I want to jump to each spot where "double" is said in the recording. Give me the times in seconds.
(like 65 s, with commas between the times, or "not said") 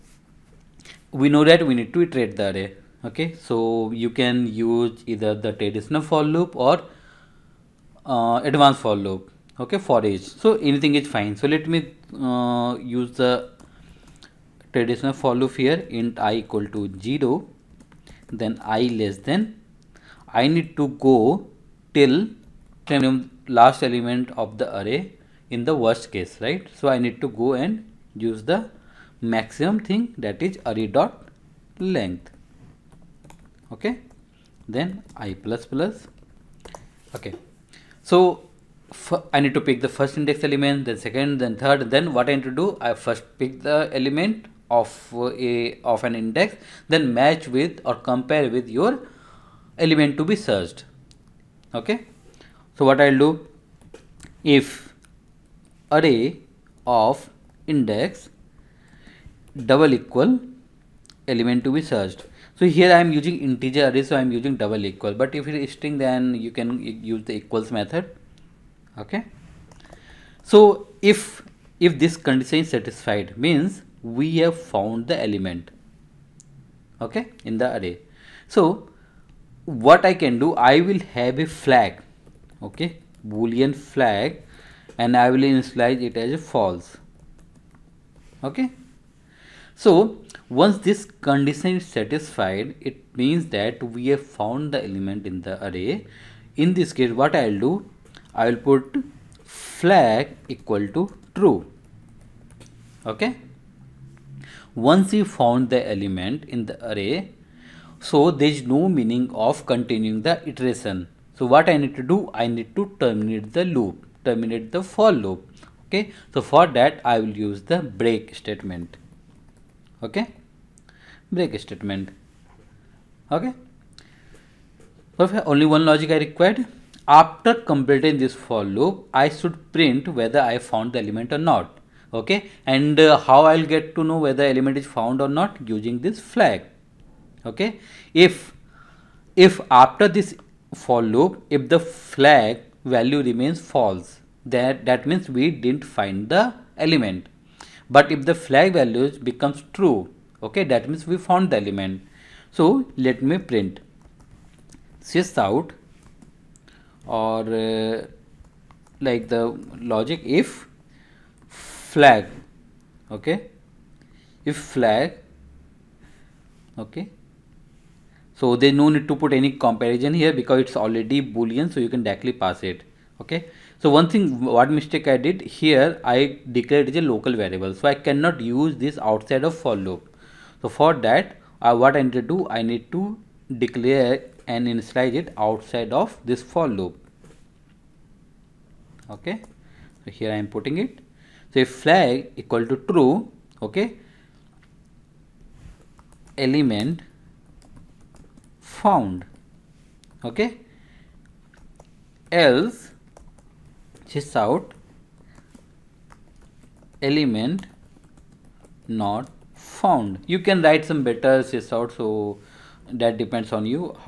59 s, 64 s.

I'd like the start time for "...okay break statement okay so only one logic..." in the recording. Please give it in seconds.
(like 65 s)
120 s.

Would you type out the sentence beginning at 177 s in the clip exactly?
So I cannot use this outside of for loop.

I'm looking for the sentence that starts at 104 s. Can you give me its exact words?
Once we found the element in the array, so there is no meaning of continuing the iteration.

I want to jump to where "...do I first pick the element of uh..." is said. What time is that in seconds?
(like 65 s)
42 s.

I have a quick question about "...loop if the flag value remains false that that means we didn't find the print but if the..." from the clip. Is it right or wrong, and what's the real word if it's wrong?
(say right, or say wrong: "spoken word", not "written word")
wrong: "element", not "print".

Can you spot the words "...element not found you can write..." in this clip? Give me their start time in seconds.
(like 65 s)
207 s.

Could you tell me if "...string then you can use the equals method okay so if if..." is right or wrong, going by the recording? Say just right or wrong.
right.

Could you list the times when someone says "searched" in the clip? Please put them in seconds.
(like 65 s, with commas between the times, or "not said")
50 s, 61 s.